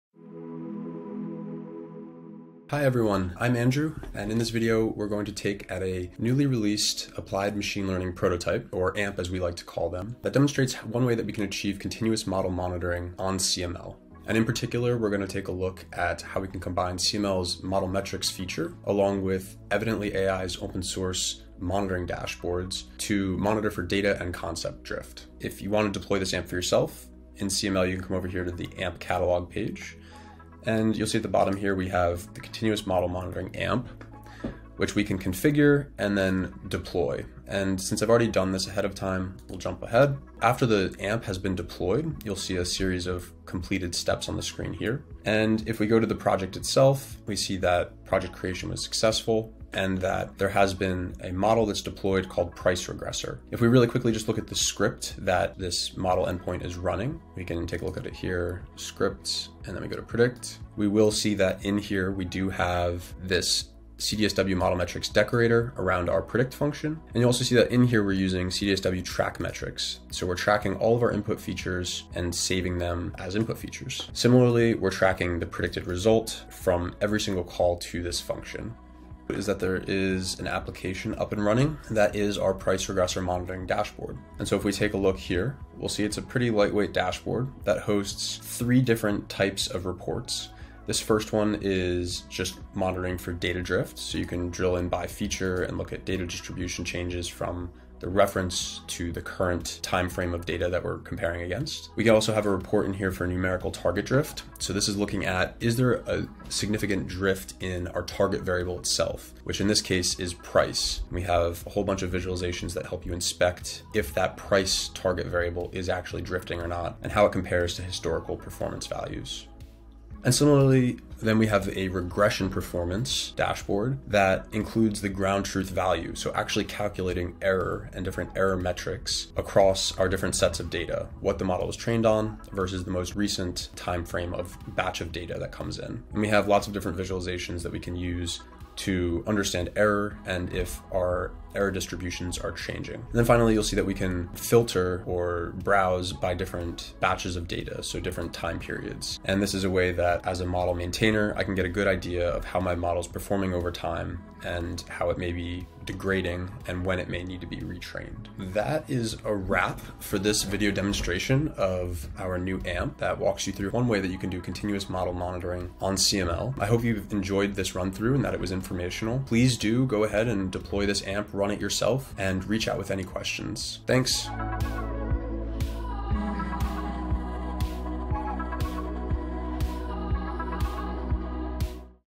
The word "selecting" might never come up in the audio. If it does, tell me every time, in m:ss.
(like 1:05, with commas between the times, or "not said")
not said.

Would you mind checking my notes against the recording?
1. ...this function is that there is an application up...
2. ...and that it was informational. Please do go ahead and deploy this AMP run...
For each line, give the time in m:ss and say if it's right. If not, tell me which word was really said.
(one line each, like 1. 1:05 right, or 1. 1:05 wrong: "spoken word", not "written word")
1. 1:18 right
2. 2:48 right.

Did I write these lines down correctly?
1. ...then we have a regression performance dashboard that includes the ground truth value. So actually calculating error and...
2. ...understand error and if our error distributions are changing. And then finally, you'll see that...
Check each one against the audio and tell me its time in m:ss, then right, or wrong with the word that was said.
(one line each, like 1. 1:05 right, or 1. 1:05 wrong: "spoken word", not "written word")
1. 2:01 right
2. 2:19 right.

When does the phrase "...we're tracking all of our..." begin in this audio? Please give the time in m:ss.
1:10.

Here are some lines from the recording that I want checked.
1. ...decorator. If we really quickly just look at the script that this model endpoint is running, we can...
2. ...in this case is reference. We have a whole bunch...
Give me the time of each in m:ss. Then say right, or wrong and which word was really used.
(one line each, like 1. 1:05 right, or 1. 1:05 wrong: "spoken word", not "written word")
1. 0:52 wrong: "regressor", not "decorator"
2. 1:49 wrong: "price", not "reference".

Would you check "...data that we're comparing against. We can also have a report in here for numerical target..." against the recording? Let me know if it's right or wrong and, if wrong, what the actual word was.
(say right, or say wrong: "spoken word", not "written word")
right.